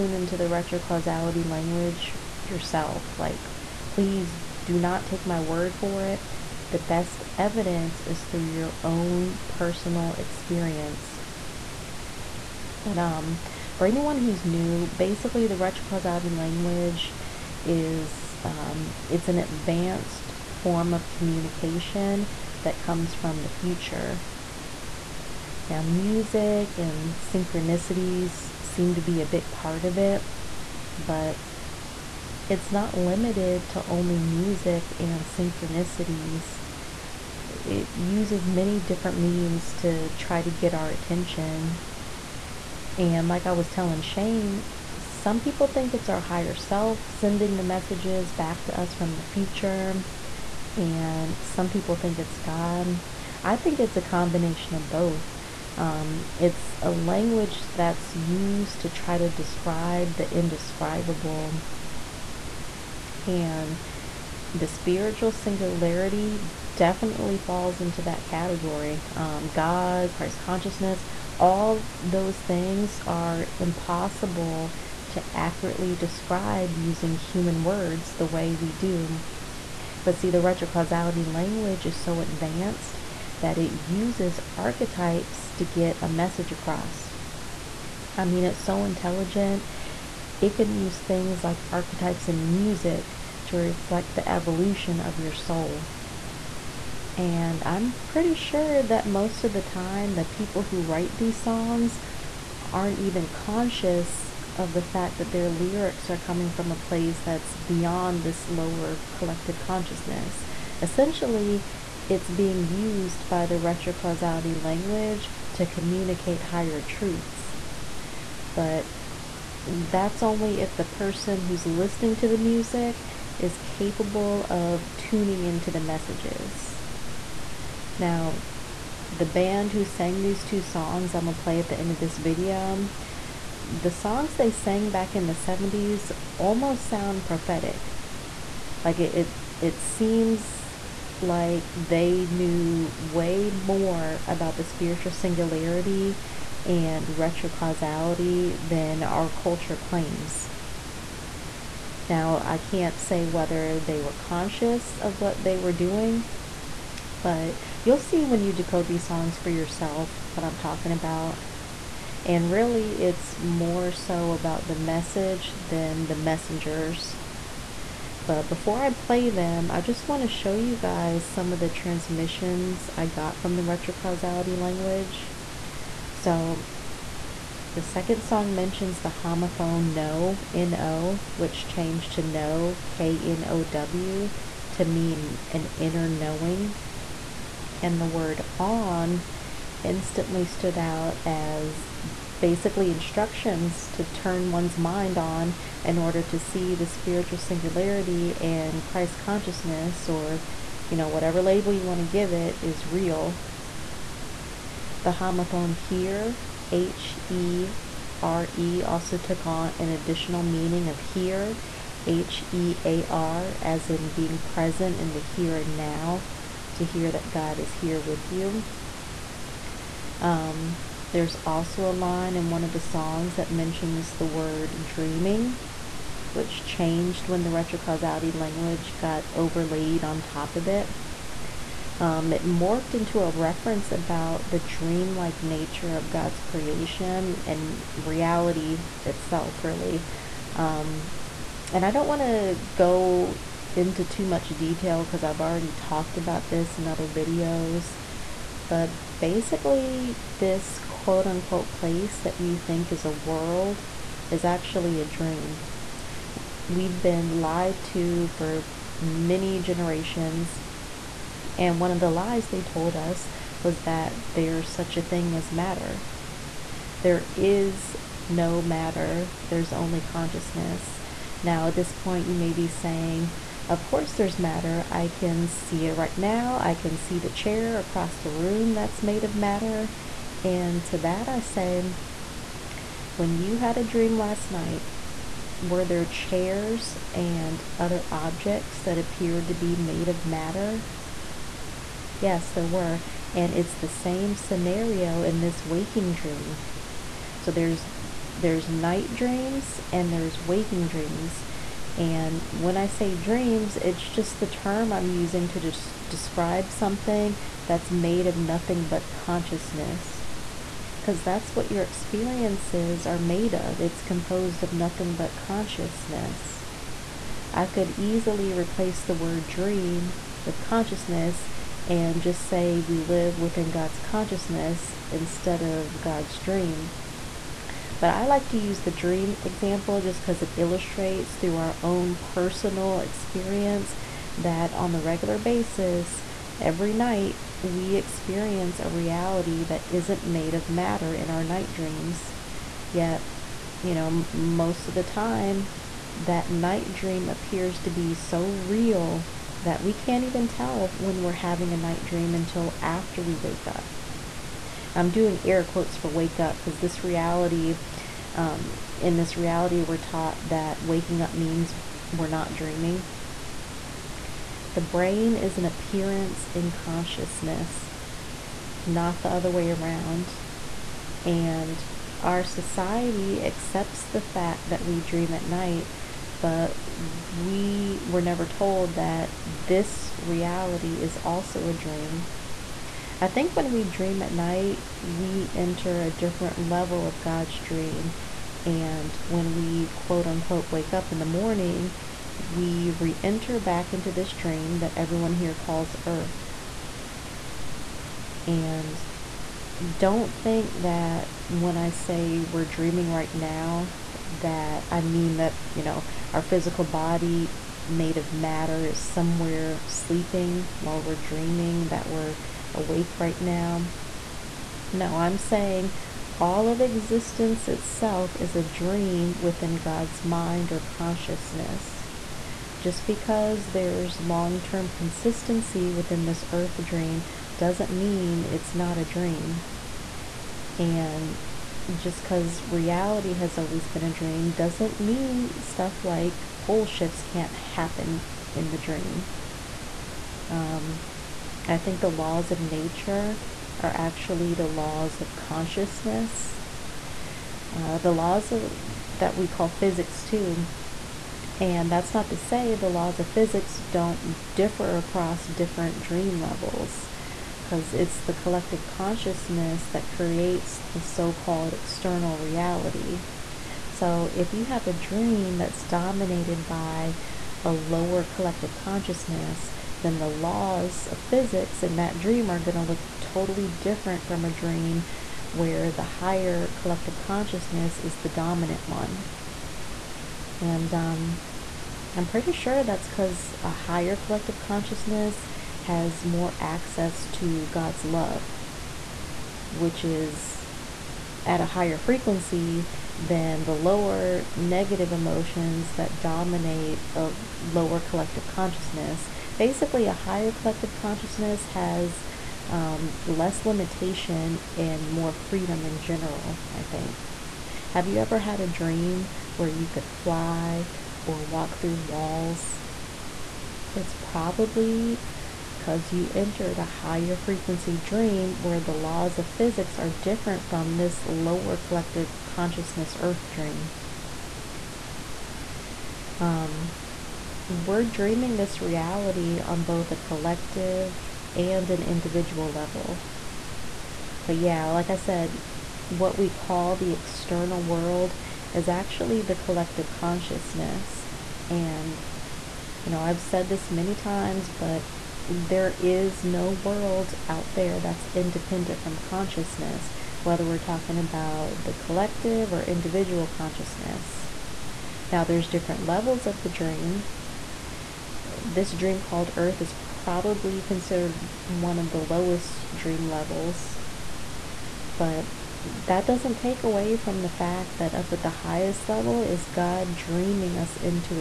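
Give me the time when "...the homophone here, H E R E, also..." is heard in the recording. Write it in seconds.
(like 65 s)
205 s.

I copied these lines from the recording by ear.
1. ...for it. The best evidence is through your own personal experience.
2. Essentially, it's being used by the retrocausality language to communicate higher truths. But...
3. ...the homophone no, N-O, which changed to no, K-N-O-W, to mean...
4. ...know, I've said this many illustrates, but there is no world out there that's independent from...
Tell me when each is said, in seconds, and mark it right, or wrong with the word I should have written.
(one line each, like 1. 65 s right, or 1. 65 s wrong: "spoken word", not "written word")
1. 5 s right
2. 110 s right
3. 179 s right
4. 543 s wrong: "times", not "illustrates".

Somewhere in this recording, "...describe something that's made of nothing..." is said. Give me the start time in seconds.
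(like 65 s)
306 s.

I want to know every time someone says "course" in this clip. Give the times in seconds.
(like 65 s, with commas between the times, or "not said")
273 s.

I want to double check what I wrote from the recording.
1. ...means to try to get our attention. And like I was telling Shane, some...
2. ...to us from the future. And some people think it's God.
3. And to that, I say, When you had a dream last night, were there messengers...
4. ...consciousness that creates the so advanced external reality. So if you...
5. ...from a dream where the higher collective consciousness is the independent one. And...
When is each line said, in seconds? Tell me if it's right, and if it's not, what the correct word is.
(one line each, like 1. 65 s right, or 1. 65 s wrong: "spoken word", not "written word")
1. 39 s right
2. 48 s right
3. 280 s wrong: "chairs", not "messengers"
4. 458 s wrong: "called", not "advanced"
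5. 474 s wrong: "dominant", not "independent".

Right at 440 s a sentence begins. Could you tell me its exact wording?
Um, I think the laws of nature are actually the laws of consciousness.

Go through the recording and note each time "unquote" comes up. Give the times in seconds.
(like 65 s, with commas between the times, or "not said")
251 s, 390 s.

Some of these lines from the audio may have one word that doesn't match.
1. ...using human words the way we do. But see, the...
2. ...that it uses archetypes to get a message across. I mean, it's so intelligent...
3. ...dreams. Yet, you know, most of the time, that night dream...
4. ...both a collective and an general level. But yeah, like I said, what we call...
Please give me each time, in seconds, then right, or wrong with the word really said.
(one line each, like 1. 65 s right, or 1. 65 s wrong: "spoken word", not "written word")
1. 76 s right
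2. 83 s right
3. 341 s right
4. 529 s wrong: "individual", not "general".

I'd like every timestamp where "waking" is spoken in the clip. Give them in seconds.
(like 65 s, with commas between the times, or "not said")
295 s, 300 s, 360 s.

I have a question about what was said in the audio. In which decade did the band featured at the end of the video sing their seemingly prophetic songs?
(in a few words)
the 70s.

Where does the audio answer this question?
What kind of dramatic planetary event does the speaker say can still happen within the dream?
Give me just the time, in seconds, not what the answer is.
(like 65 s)
436 s.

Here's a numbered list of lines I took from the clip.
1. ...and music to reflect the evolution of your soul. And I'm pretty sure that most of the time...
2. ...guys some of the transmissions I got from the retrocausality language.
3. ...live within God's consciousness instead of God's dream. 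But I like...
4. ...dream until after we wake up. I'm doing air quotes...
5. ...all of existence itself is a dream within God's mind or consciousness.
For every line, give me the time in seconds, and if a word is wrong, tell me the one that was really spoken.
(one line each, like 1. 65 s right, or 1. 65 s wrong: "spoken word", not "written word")
1. 92 s right
2. 170 s right
3. 322 s right
4. 352 s right
5. 416 s right.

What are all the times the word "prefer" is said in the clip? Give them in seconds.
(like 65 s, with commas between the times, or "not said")
not said.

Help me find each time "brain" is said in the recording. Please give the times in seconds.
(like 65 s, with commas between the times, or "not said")
364 s.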